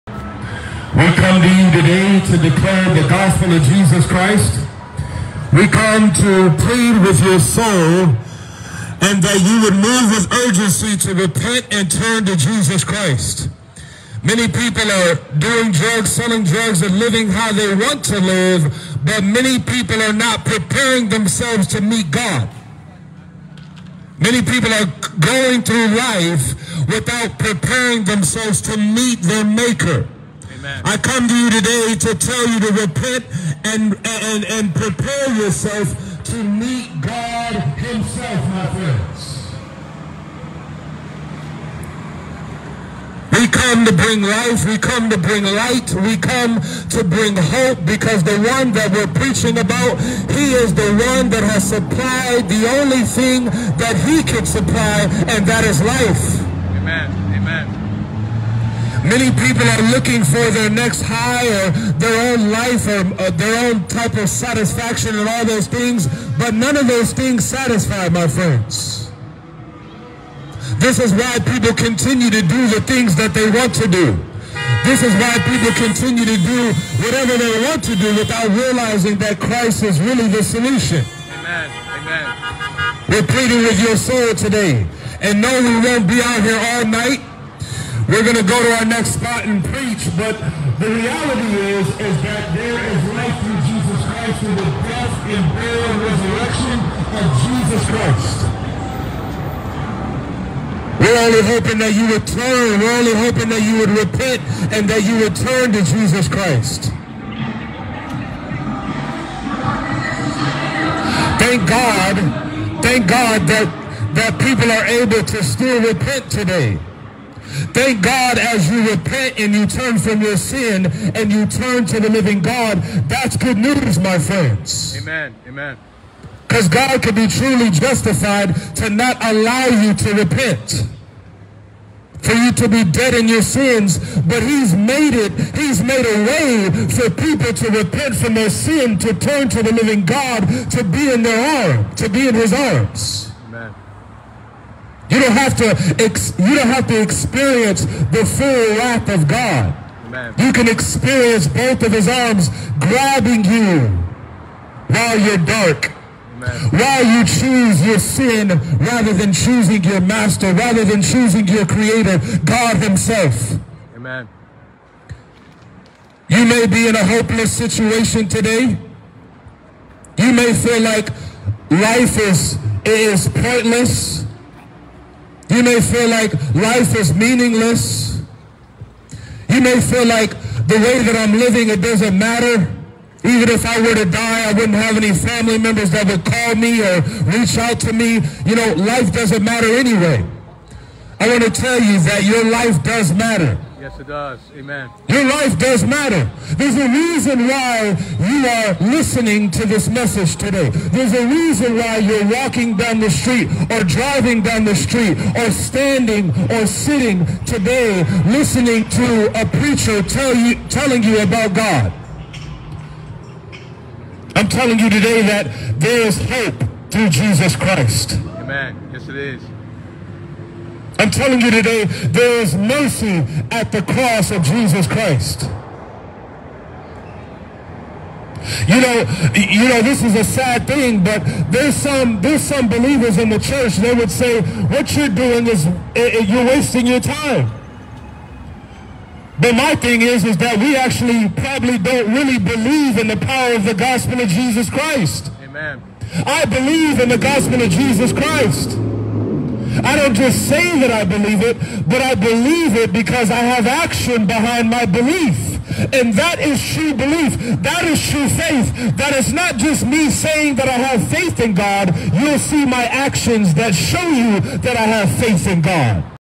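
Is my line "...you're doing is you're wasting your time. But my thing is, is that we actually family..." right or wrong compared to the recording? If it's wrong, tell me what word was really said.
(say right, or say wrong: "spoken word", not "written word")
wrong: "probably", not "family".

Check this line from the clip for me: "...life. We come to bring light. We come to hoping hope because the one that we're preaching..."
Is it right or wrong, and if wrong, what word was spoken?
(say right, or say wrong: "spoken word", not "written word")
wrong: "bring", not "hoping".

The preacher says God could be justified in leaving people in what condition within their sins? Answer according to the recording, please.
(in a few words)
dead.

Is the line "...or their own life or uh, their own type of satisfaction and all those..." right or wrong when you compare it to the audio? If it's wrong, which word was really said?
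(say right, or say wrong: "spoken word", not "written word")
right.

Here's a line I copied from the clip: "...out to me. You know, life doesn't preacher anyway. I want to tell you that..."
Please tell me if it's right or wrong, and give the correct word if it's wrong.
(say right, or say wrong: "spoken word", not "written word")
wrong: "matter", not "preacher".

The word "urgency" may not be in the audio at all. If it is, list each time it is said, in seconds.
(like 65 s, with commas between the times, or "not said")
10 s.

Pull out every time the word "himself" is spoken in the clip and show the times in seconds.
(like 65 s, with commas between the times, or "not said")
37 s, 162 s.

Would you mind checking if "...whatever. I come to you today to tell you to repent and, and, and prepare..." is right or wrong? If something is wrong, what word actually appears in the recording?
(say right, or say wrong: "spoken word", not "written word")
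wrong: "maker", not "whatever".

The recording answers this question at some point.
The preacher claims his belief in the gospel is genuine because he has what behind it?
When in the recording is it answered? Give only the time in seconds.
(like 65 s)
253 s.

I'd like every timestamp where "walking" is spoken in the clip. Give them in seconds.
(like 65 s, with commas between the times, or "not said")
202 s.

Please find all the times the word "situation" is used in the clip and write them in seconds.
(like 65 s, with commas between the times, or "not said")
167 s.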